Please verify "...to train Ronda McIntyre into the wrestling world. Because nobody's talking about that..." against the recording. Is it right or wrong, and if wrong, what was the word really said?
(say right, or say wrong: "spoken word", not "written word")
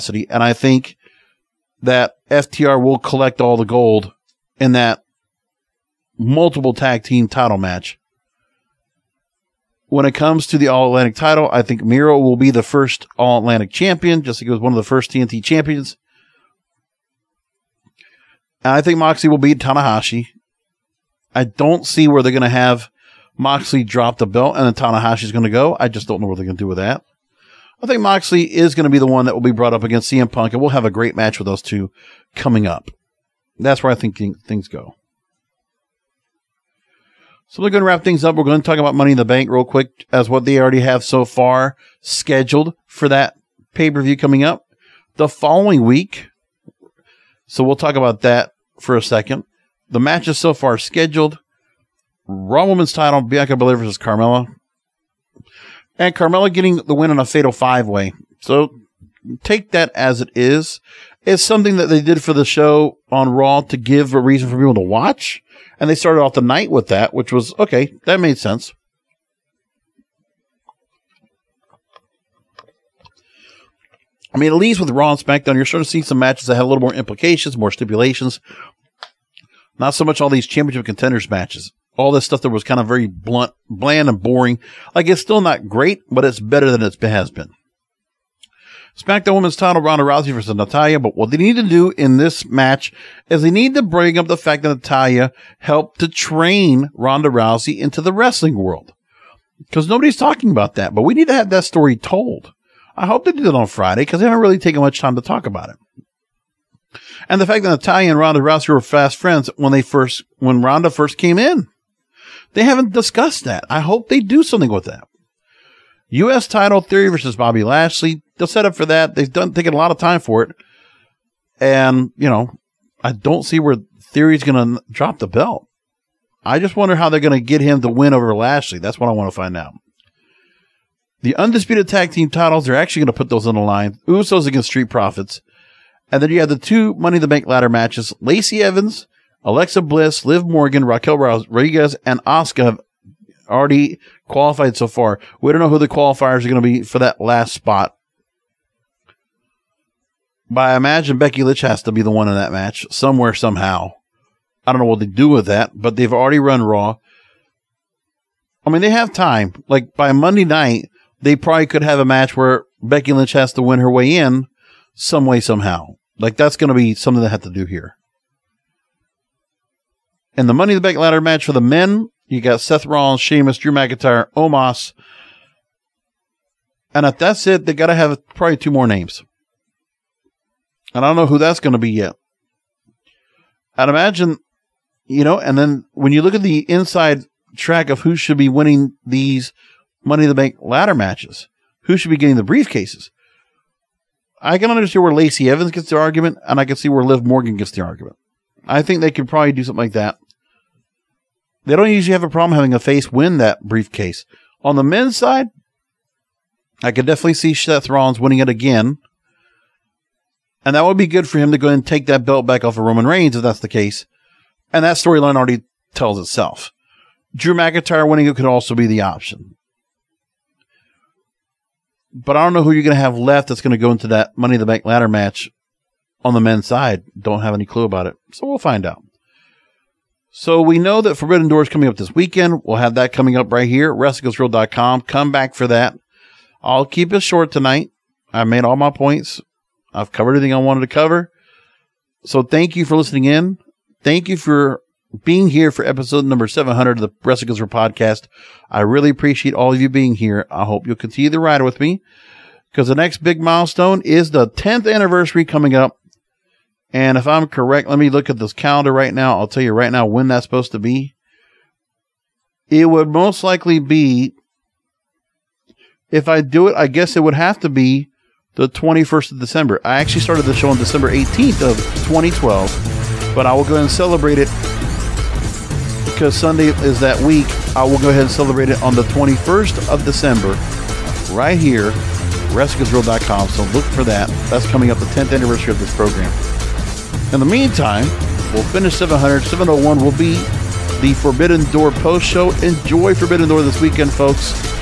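wrong: "Rousey", not "McIntyre".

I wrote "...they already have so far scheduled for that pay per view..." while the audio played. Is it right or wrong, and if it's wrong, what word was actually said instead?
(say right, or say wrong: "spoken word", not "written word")
right.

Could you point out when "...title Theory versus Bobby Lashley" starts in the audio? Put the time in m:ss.
1:56.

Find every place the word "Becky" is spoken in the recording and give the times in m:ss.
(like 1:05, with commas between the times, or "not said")
2:31, 2:42.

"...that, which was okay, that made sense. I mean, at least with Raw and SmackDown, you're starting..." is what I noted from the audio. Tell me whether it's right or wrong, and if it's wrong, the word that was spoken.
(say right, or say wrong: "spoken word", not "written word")
right.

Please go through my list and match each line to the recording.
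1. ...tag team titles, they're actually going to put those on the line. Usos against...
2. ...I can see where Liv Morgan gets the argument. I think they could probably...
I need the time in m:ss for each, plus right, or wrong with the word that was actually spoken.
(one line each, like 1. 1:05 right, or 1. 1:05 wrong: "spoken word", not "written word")
1. 2:11 right
2. 3:16 right.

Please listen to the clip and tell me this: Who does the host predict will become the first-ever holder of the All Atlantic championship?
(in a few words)
Miro.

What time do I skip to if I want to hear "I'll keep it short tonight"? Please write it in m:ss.
3:56.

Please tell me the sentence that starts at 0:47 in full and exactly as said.
So we'll talk about that for a second.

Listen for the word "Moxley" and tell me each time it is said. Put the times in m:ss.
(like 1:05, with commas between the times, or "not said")
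0:23, 0:27.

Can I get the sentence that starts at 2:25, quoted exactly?
We don't know who the qualifiers are going to be for that last spot.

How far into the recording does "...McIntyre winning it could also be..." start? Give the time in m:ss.
3:37.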